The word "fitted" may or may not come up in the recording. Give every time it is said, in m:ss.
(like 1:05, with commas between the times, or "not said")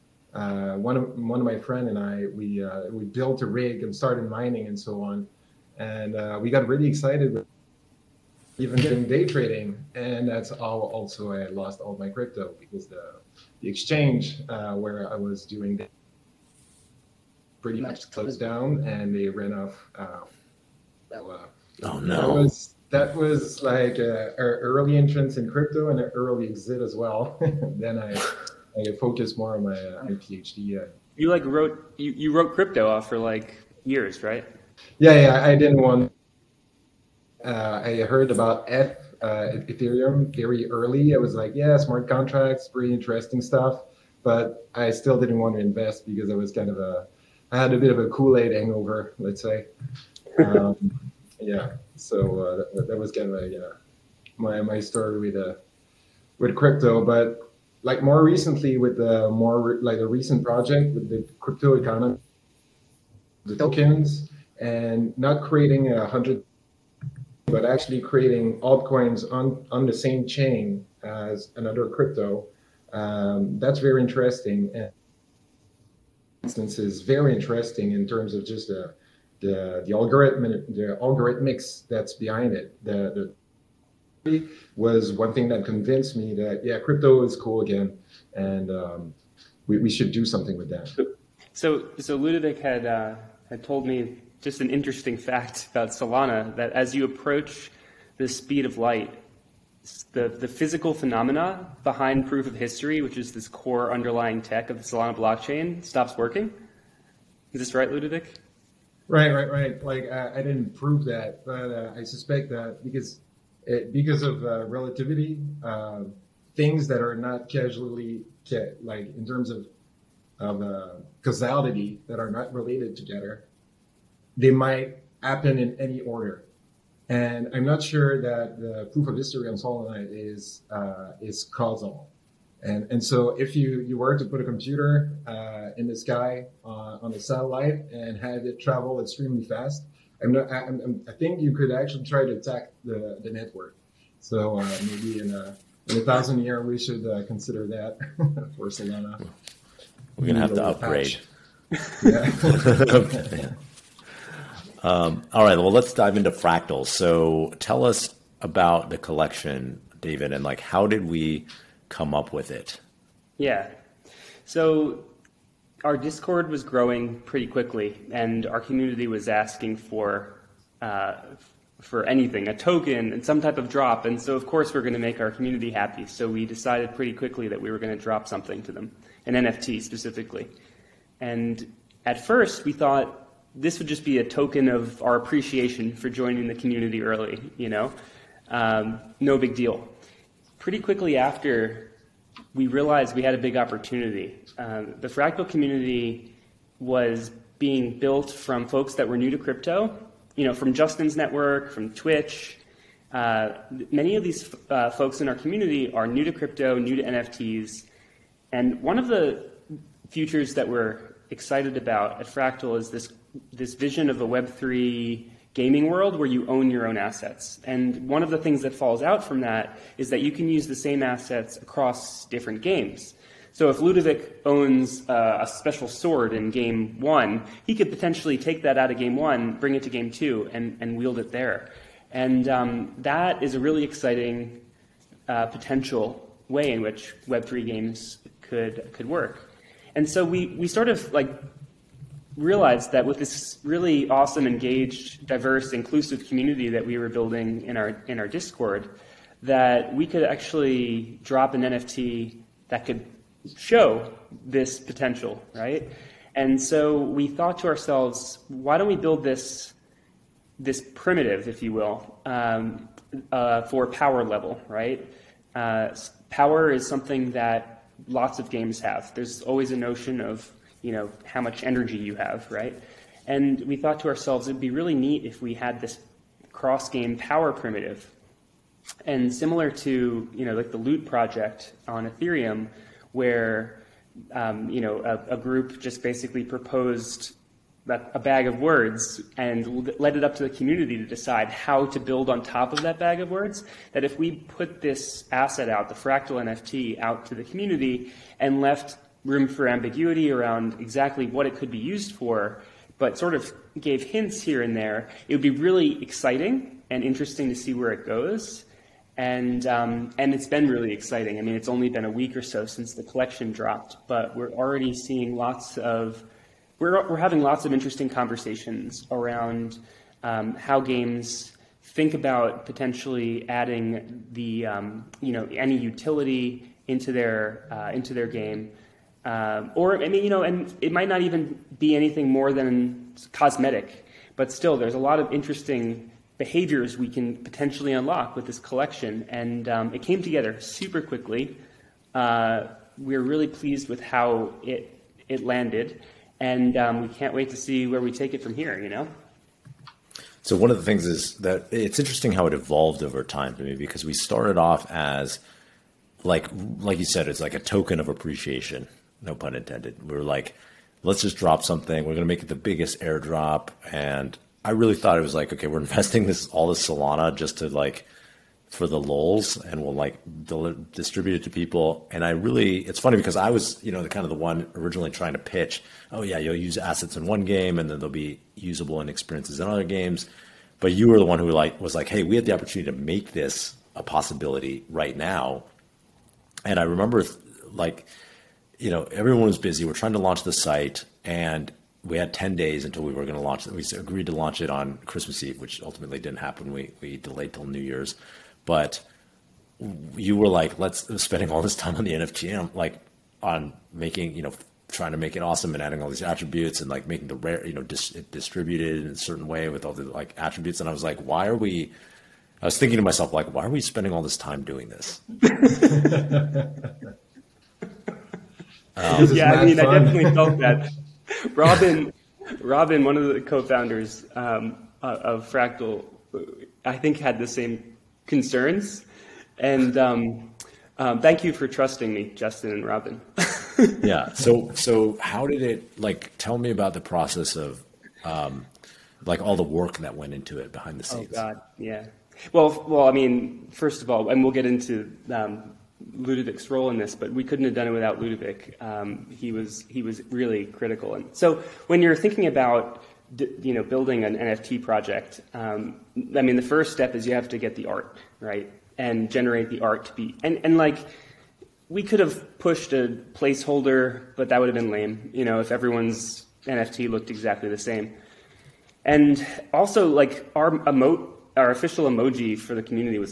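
not said.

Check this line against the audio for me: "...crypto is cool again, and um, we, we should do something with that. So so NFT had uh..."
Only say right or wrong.
wrong.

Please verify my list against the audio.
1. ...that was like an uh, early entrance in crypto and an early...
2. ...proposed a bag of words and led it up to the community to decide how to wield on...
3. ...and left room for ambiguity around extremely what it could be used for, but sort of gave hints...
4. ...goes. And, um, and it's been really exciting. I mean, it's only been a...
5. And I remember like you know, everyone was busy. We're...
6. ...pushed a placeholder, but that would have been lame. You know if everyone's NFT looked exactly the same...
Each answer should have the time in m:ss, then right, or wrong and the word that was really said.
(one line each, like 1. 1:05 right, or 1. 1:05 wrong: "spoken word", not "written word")
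1. 0:22 right
2. 4:46 wrong: "build", not "wield"
3. 4:58 wrong: "exactly", not "extremely"
4. 5:08 right
5. 6:26 right
6. 7:42 right.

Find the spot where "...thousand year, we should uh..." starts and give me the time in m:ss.
2:26.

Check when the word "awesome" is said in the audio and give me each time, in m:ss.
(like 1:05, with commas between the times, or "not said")
4:04, 6:45.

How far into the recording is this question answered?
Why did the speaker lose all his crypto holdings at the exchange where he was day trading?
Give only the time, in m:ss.
0:18.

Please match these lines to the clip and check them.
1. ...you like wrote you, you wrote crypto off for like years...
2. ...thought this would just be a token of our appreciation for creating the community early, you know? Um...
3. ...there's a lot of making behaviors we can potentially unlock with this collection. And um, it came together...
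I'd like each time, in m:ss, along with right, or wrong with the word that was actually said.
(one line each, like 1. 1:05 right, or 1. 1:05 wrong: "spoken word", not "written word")
1. 0:31 right
2. 3:02 wrong: "joining", not "creating"
3. 5:34 wrong: "interesting", not "making".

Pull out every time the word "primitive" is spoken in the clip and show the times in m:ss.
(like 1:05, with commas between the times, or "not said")
4:20, 4:37.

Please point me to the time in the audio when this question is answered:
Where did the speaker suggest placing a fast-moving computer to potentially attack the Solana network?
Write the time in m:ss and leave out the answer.
2:17.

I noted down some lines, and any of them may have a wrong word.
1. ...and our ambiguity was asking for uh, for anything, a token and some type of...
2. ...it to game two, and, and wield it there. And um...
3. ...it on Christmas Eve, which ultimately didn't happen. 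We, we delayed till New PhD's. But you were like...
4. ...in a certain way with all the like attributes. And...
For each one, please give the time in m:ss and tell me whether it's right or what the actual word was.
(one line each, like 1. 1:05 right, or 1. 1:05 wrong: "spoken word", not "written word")
1. 2:48 wrong: "community", not "ambiguity"
2. 3:49 right
3. 6:34 wrong: "Year", not "PhD"
4. 6:49 right.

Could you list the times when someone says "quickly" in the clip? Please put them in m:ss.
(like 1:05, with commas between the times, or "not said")
2:47, 2:57, 3:10, 5:41.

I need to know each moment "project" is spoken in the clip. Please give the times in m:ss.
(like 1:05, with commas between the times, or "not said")
1:00, 4:41, 7:34.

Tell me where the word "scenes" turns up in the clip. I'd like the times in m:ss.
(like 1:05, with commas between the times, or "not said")
7:21.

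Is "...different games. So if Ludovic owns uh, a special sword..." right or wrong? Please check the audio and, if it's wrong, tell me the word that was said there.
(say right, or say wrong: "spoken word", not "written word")
right.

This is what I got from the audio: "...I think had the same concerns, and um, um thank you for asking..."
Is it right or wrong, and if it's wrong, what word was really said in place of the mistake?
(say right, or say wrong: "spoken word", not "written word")
wrong: "trusting", not "asking".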